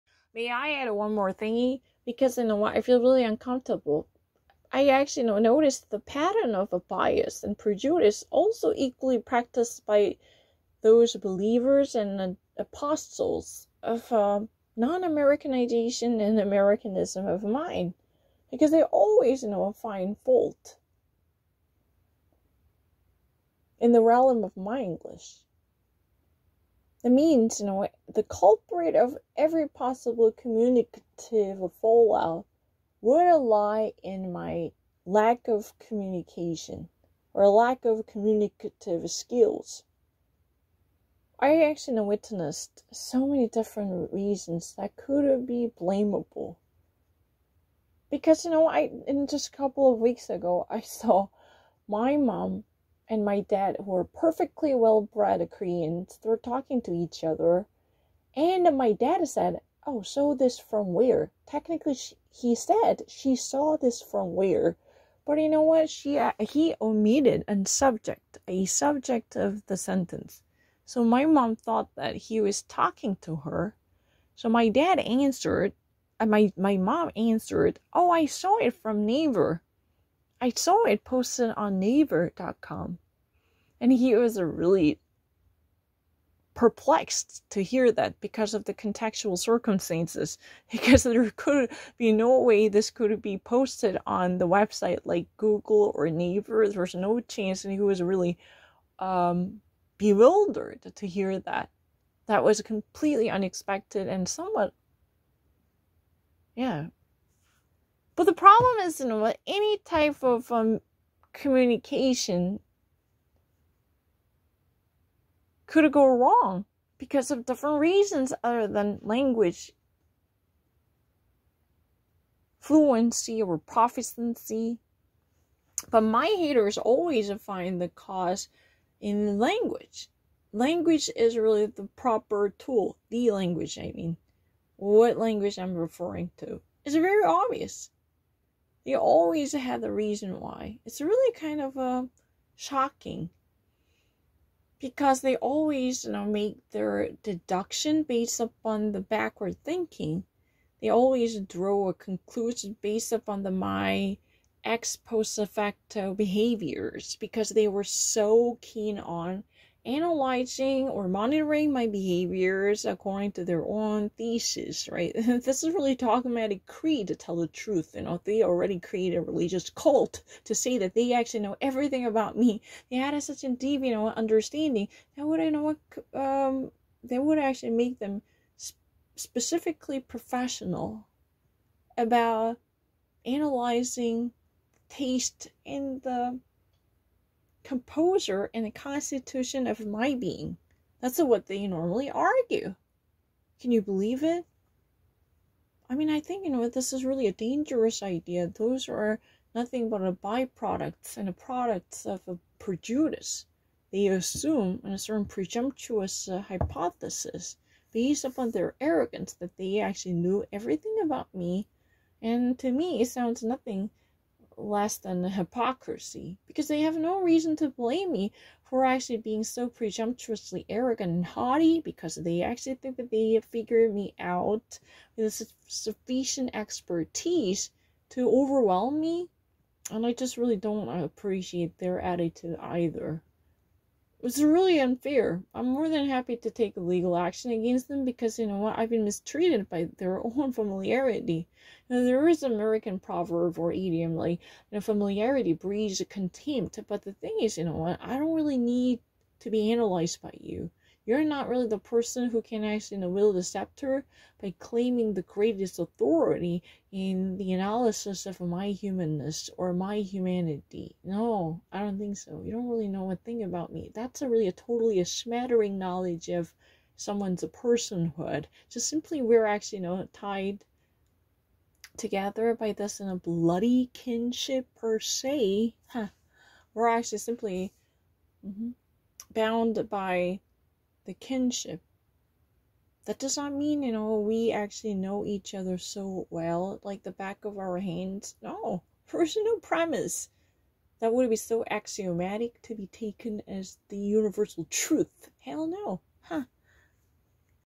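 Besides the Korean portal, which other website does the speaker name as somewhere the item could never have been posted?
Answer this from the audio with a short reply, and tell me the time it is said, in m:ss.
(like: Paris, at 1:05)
Google, at 1:35.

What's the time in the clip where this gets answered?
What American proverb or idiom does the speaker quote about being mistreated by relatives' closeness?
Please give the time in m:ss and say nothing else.
4:04.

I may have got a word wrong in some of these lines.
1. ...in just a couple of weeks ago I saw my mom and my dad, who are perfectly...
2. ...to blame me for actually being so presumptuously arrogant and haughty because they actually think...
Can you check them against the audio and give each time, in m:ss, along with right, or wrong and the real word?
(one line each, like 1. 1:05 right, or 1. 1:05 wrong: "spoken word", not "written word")
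1. 0:49 right
2. 3:37 right.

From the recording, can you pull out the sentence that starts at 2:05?
But my haters always find the cause in language.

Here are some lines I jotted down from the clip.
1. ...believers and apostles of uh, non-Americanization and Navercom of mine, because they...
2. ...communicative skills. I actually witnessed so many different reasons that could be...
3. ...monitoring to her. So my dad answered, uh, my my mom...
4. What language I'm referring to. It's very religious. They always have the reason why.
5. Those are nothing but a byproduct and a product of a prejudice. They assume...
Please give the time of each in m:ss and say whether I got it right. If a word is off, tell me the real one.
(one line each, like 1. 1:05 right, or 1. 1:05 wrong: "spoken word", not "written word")
1. 0:11 wrong: "Americanism", not "Navercom"
2. 0:38 right
3. 1:12 wrong: "talking", not "monitoring"
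4. 2:14 wrong: "obvious", not "religious"
5. 3:18 right.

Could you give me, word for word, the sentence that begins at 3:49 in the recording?
And I just really don't appreciate their attitude either.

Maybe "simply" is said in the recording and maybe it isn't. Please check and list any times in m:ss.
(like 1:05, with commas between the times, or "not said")
4:28, 4:37.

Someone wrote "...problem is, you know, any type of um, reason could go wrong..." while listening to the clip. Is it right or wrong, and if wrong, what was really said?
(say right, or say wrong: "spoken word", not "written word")
wrong: "communication", not "reason".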